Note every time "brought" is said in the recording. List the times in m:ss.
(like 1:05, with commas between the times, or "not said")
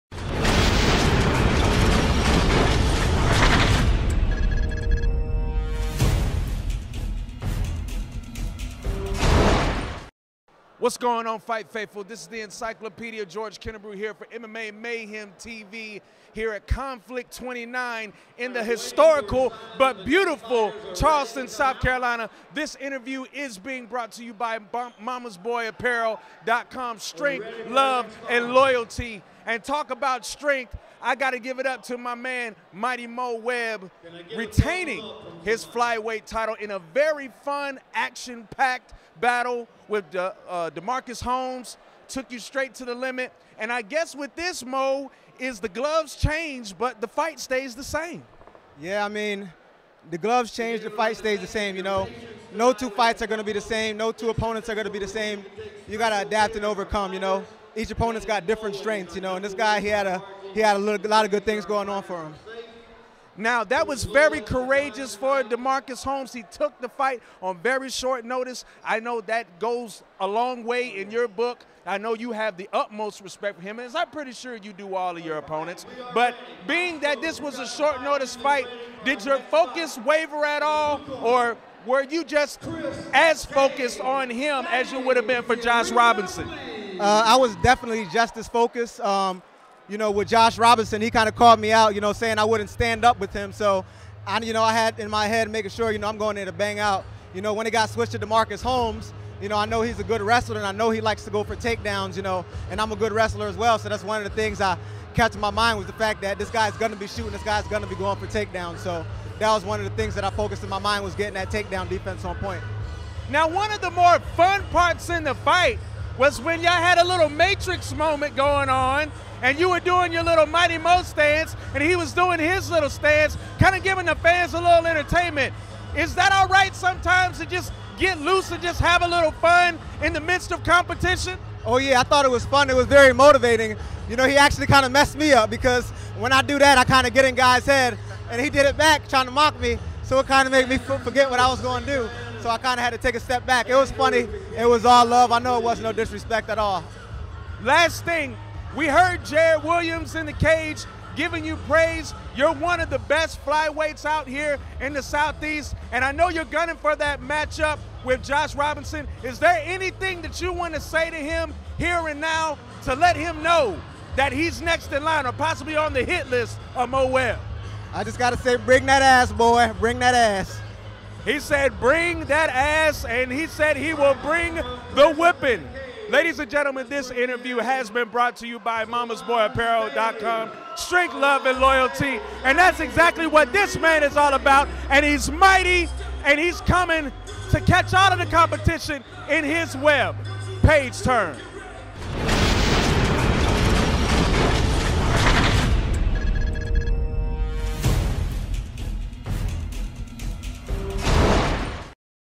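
0:23, 2:58.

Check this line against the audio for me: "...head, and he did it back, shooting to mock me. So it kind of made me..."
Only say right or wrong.
wrong.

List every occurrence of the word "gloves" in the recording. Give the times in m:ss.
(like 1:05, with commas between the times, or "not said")
0:45, 0:50.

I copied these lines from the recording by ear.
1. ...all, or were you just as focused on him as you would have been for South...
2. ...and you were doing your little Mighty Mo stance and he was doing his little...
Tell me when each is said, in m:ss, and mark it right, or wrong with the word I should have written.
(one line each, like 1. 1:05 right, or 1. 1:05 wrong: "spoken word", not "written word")
1. 1:20 wrong: "Josh", not "South"
2. 1:59 right.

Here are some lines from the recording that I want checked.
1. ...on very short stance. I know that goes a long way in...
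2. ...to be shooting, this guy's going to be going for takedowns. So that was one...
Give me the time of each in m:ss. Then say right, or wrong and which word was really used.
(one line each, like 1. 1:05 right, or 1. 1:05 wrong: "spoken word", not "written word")
1. 1:07 wrong: "notice", not "stance"
2. 1:46 right.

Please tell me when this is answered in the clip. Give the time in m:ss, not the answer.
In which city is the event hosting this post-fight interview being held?
0:20.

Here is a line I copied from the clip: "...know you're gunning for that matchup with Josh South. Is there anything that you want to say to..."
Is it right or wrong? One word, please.
wrong.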